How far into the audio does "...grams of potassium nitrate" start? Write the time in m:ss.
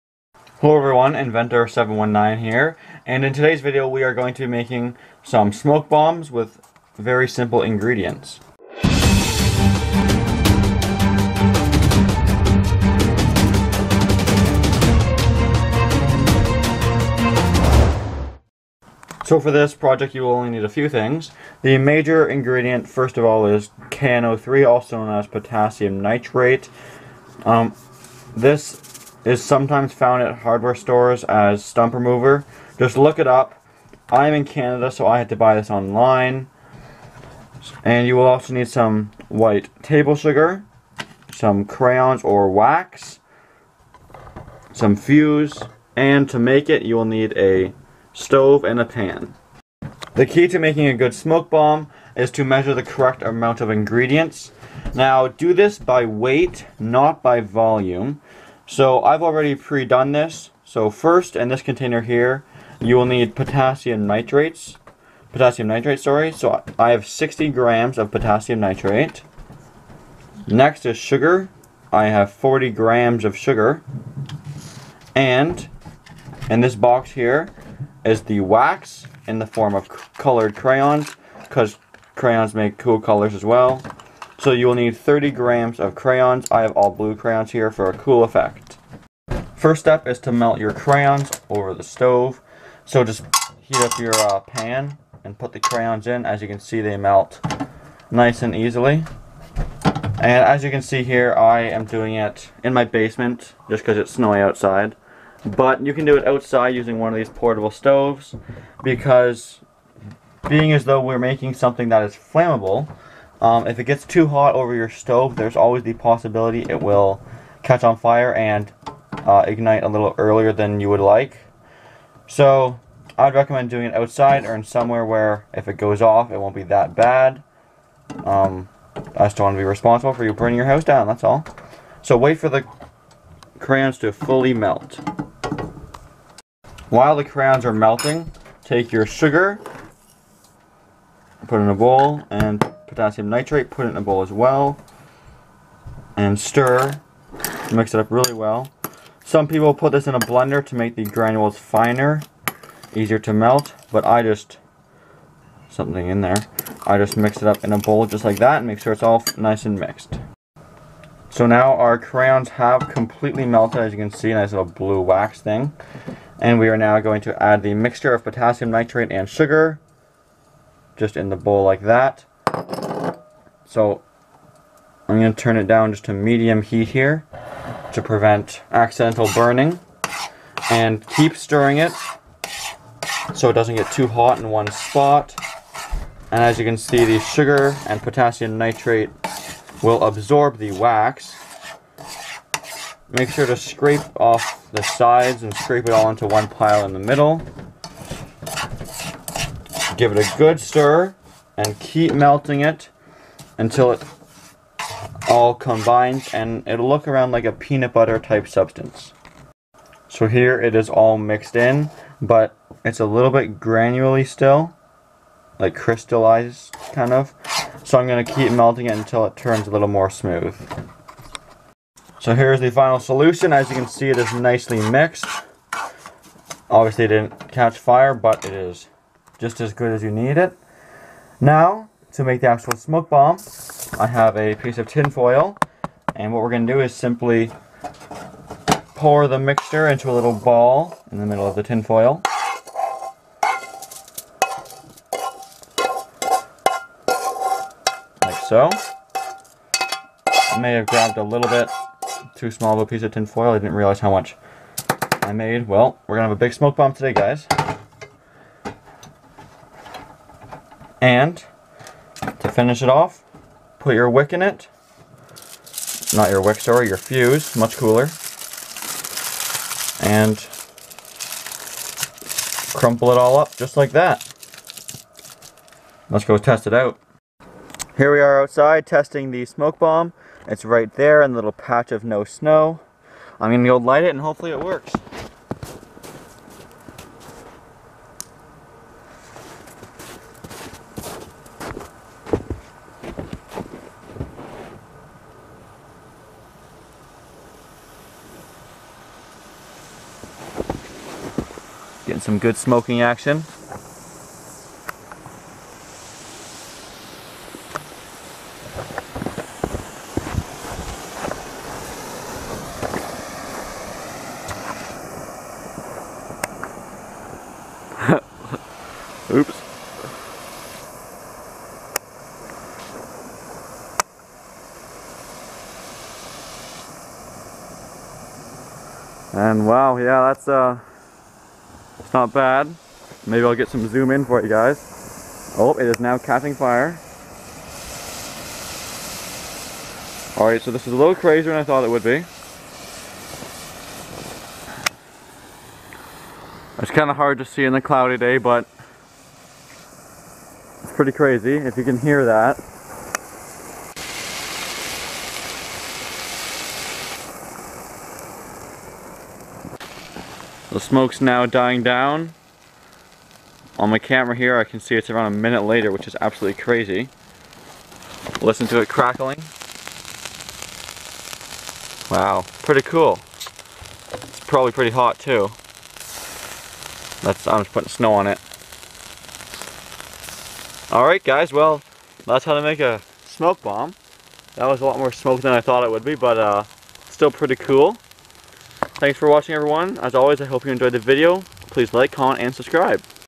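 1:07.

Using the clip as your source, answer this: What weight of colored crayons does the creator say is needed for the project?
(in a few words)
30 grams.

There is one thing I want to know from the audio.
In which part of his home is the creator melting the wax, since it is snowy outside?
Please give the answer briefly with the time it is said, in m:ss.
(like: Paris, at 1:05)
basement, at 1:42.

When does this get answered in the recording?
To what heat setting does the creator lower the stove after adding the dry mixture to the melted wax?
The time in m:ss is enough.
2:56.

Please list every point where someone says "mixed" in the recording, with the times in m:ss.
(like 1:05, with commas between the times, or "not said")
2:39, 3:31, 3:44.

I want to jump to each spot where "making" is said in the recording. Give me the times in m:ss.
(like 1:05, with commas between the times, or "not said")
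0:04, 0:50, 1:51.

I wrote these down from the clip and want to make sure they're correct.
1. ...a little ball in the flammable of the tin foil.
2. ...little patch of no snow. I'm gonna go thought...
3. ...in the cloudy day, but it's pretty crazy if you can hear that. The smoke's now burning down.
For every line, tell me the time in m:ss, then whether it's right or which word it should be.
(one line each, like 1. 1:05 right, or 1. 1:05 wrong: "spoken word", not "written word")
1. 4:00 wrong: "middle", not "flammable"
2. 4:41 wrong: "light", not "thought"
3. 5:47 wrong: "dying", not "burning".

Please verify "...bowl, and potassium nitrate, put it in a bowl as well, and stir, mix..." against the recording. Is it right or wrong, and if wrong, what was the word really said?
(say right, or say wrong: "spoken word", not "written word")
right.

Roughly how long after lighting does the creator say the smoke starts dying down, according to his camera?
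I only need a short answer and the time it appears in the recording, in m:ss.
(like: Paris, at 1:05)
a minute, at 6:05.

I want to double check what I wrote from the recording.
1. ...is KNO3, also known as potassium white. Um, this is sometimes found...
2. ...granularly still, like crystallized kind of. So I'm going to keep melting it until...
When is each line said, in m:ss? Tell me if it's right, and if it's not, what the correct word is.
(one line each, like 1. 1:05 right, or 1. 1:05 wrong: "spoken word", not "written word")
1. 0:23 wrong: "nitrate", not "white"
2. 3:33 right.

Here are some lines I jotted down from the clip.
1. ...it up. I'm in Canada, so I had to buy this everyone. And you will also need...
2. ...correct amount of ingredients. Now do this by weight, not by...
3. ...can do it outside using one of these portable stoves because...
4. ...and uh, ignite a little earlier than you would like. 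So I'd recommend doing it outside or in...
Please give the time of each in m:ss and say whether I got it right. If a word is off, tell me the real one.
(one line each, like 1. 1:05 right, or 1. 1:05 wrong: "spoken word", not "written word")
1. 0:33 wrong: "online", not "everyone"
2. 0:52 right
3. 1:45 right
4. 1:58 right.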